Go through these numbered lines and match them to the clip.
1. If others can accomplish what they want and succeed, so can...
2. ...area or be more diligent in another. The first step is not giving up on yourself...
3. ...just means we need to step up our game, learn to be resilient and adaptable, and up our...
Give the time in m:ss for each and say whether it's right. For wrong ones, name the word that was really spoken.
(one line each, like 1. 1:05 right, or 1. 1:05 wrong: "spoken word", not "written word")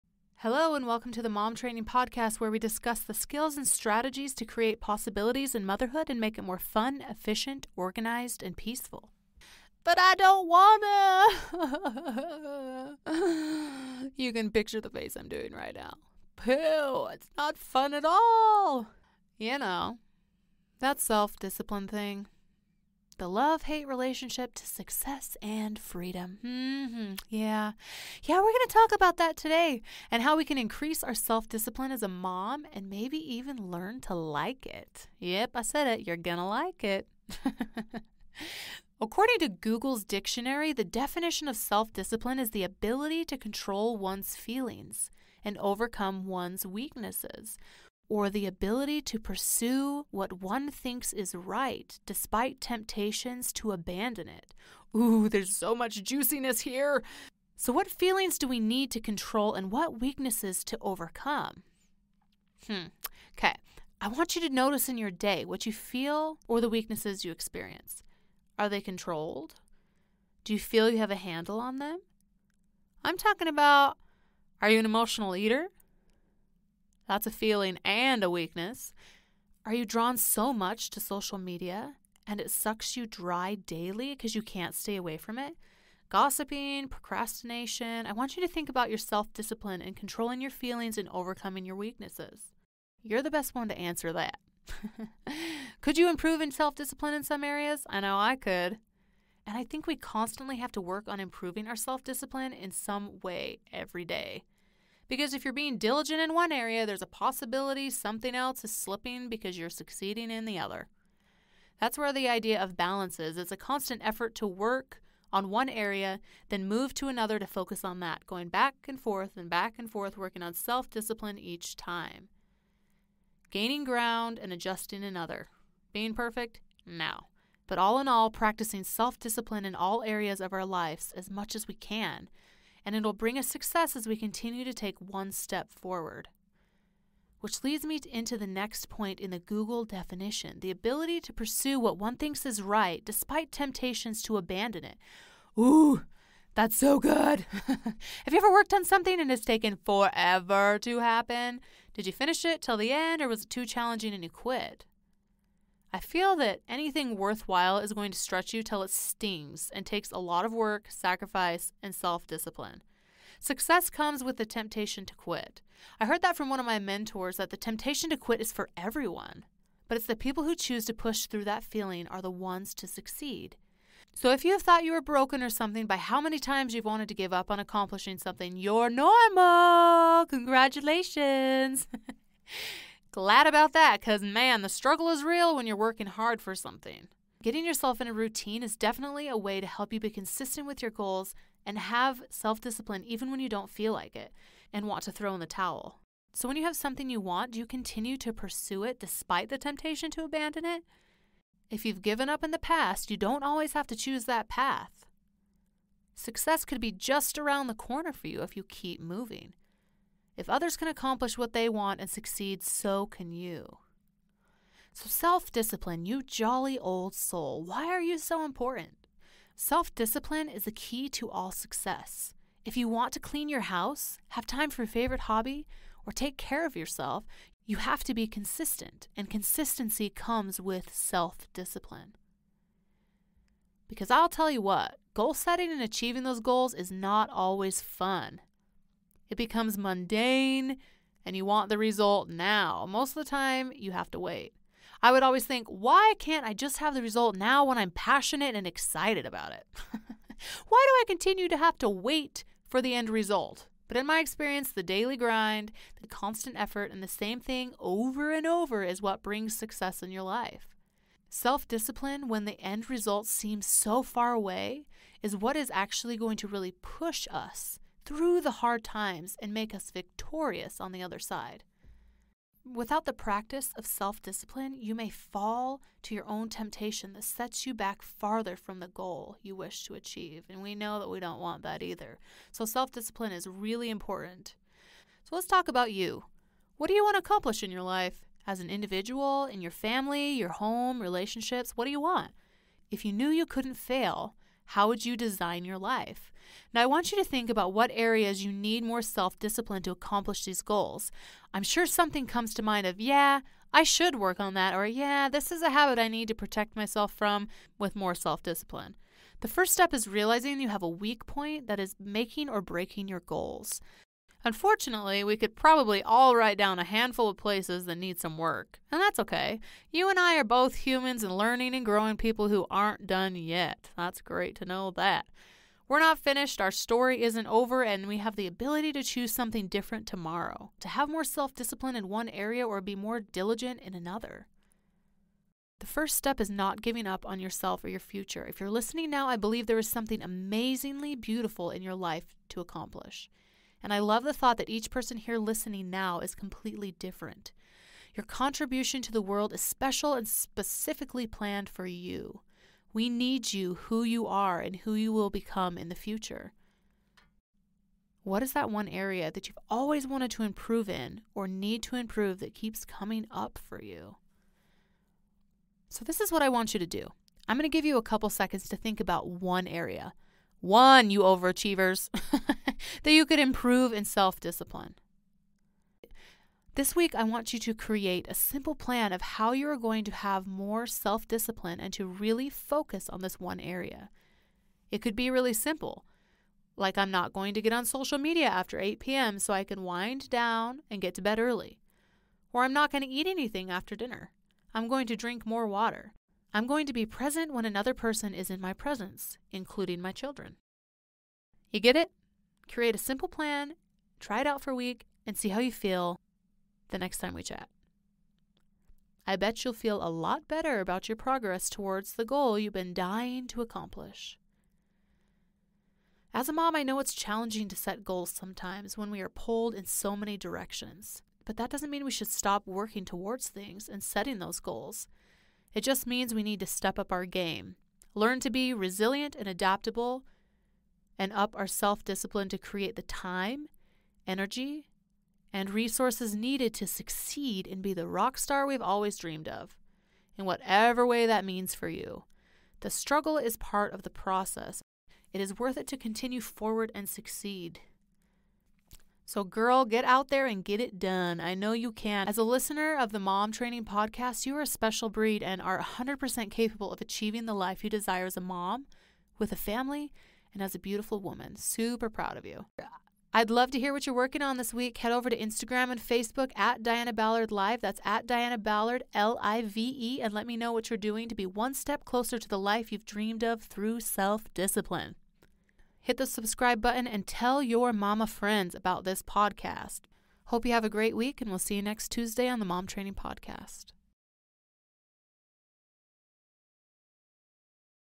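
1. 3:30 right
2. 5:32 right
3. 7:05 right.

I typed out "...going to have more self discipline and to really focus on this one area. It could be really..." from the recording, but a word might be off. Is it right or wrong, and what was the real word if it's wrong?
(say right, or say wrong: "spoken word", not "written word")
right.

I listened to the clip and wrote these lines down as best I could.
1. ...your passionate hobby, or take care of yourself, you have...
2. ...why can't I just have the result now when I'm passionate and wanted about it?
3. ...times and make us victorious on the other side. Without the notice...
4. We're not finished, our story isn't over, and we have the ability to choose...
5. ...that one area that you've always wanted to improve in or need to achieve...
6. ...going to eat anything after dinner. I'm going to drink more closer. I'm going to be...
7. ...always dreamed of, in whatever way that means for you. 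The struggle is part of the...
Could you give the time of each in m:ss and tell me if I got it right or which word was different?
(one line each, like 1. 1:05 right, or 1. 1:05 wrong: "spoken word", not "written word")
1. 3:44 wrong: "favorite", not "passionate"
2. 4:05 wrong: "excited", not "wanted"
3. 4:28 wrong: "practice", not "notice"
4. 5:25 right
5. 5:58 wrong: "improve", not "achieve"
6. 6:32 wrong: "water", not "closer"
7. 7:18 right.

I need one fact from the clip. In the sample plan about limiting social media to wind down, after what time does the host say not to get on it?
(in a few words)
8 p.m.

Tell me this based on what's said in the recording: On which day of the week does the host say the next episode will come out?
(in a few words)
Tuesday.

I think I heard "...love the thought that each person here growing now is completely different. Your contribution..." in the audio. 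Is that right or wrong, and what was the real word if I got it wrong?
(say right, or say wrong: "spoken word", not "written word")
wrong: "listening", not "growing".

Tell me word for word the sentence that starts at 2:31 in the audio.
Did you finish it till the end or was it too challenging and you quit?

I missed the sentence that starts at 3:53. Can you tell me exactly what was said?
Because I'll tell you what, goal setting and achieving those goals is not always fun.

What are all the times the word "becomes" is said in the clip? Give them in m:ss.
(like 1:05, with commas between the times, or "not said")
3:59, 5:55.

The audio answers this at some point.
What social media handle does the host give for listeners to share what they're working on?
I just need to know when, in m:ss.
7:46.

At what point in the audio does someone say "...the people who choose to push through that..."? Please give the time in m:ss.
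2:50.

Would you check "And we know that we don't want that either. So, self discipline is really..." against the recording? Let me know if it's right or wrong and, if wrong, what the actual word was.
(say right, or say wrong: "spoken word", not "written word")
right.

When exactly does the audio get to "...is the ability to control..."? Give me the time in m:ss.
0:42.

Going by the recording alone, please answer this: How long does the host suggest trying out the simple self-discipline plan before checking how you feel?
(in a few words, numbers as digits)
a week.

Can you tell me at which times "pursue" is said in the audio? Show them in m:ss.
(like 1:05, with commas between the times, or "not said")
0:49, 2:21, 3:18.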